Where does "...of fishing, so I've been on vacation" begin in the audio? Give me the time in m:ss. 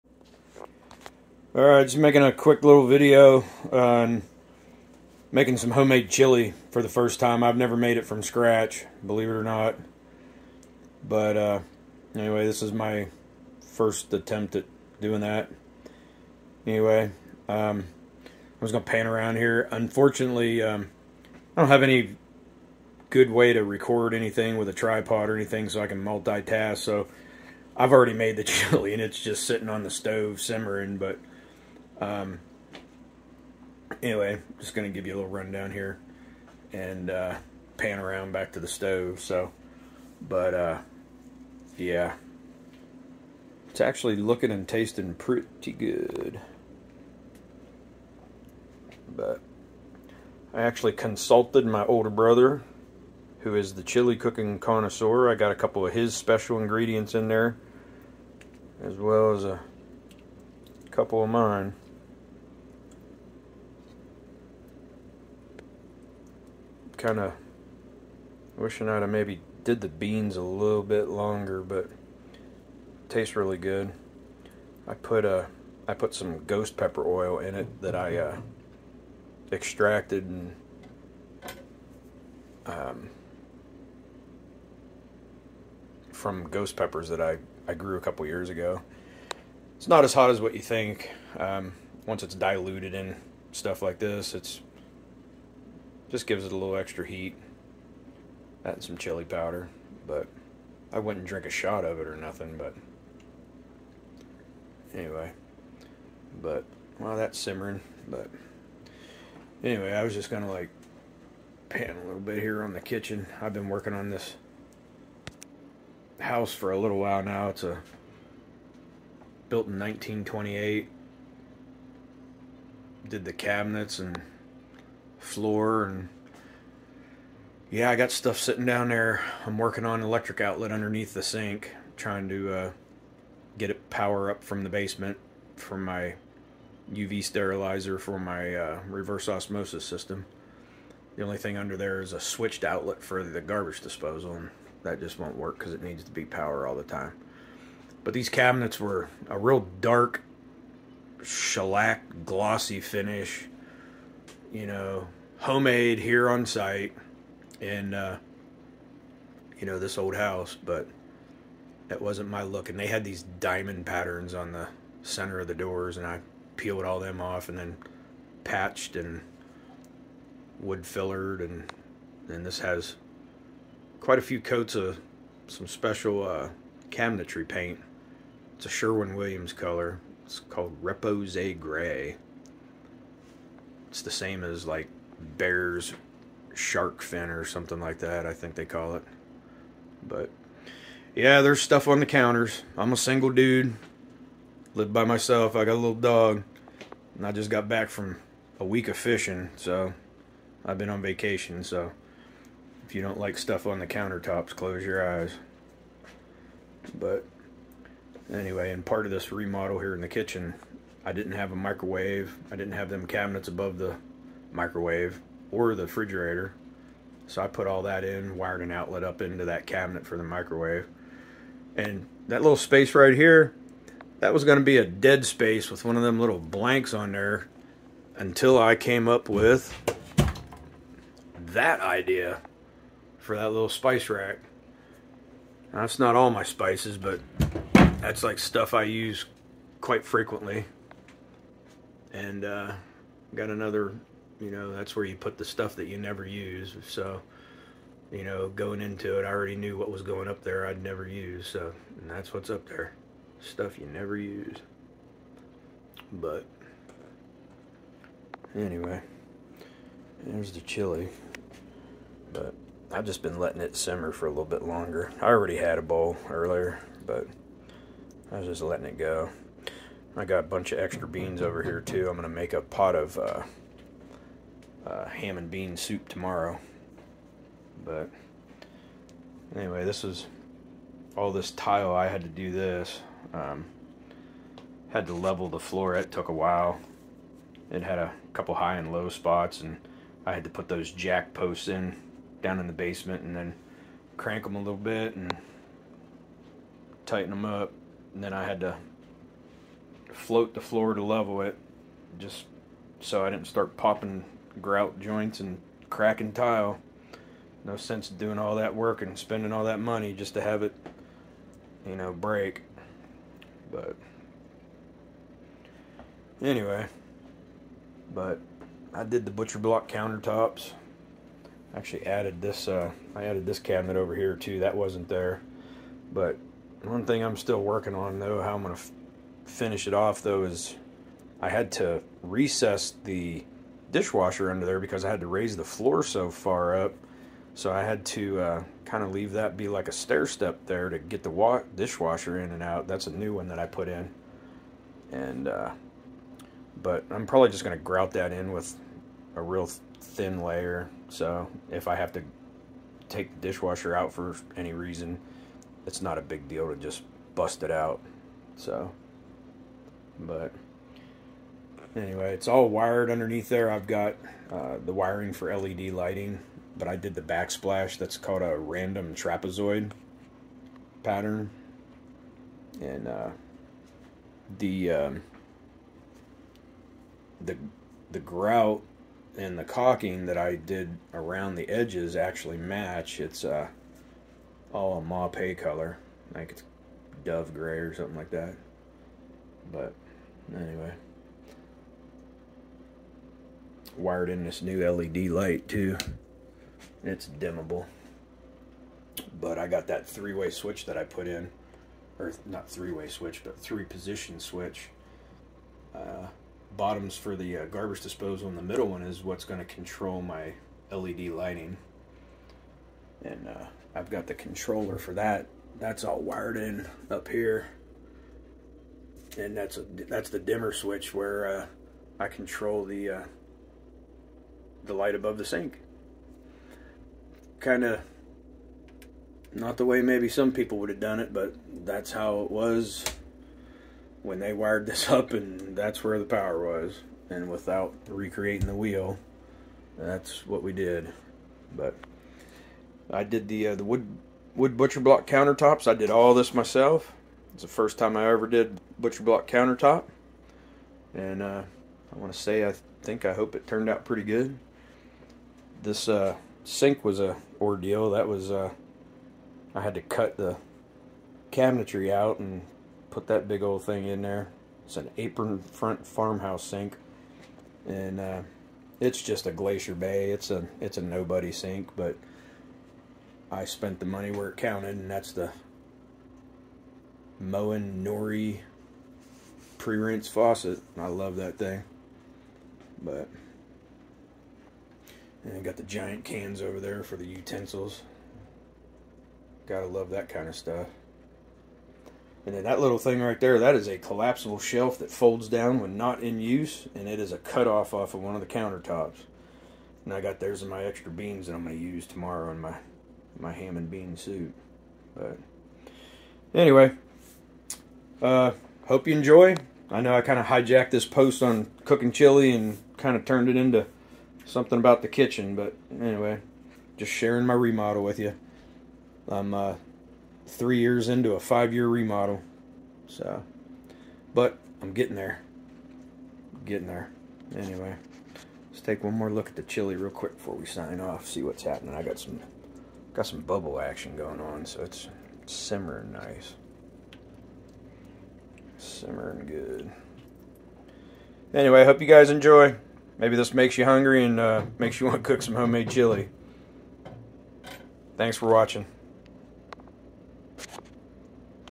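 3:18.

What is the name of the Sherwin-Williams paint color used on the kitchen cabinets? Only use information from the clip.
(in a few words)
Repose Gray.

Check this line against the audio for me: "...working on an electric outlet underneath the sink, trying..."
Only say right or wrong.
right.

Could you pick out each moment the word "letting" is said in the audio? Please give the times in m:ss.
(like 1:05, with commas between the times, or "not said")
4:23, 4:28.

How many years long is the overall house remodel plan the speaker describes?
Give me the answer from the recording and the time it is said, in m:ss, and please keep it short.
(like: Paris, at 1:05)
5 years, at 8:41.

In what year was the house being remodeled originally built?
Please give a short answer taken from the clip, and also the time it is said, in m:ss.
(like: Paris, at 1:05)
1928, at 1:59.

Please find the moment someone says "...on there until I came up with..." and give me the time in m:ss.
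3:46.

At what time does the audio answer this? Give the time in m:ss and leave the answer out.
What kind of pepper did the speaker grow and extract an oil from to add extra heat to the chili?
1:16.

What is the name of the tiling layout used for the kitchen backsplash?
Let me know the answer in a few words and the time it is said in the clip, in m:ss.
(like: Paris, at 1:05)
Random trapezoid, at 6:08.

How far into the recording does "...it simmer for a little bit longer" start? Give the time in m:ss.
4:23.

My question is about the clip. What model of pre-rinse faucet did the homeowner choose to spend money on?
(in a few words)
Moen Nori.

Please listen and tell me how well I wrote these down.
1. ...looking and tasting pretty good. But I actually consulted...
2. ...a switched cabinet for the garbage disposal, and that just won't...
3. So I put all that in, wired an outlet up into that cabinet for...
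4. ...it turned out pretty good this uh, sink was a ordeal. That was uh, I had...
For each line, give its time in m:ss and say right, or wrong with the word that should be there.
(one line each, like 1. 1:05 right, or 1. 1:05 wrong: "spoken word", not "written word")
1. 0:44 right
2. 2:22 wrong: "outlet", not "cabinet"
3. 3:37 right
4. 7:33 right.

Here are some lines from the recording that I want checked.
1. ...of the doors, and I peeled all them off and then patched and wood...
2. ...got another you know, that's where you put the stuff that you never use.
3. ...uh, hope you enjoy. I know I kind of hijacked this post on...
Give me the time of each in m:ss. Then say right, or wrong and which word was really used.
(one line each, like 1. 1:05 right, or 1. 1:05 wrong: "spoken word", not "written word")
1. 2:45 right
2. 4:03 right
3. 8:28 right.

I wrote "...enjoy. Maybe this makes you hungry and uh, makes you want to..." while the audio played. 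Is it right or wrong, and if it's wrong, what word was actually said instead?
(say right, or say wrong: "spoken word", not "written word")
right.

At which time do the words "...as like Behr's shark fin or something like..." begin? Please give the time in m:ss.
3:04.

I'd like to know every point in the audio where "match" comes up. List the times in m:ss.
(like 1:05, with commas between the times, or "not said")
6:22.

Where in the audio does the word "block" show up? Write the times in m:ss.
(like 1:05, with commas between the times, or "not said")
5:19, 7:24, 7:29.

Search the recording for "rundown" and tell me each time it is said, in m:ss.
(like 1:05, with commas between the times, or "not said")
0:35.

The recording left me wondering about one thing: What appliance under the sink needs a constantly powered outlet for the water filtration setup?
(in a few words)
UV sterilizer.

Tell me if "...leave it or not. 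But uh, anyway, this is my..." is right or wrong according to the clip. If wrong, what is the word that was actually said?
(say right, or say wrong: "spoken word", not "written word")
wrong: "believe", not "leave".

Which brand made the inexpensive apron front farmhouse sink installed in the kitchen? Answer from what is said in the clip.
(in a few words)
Glacier Bay.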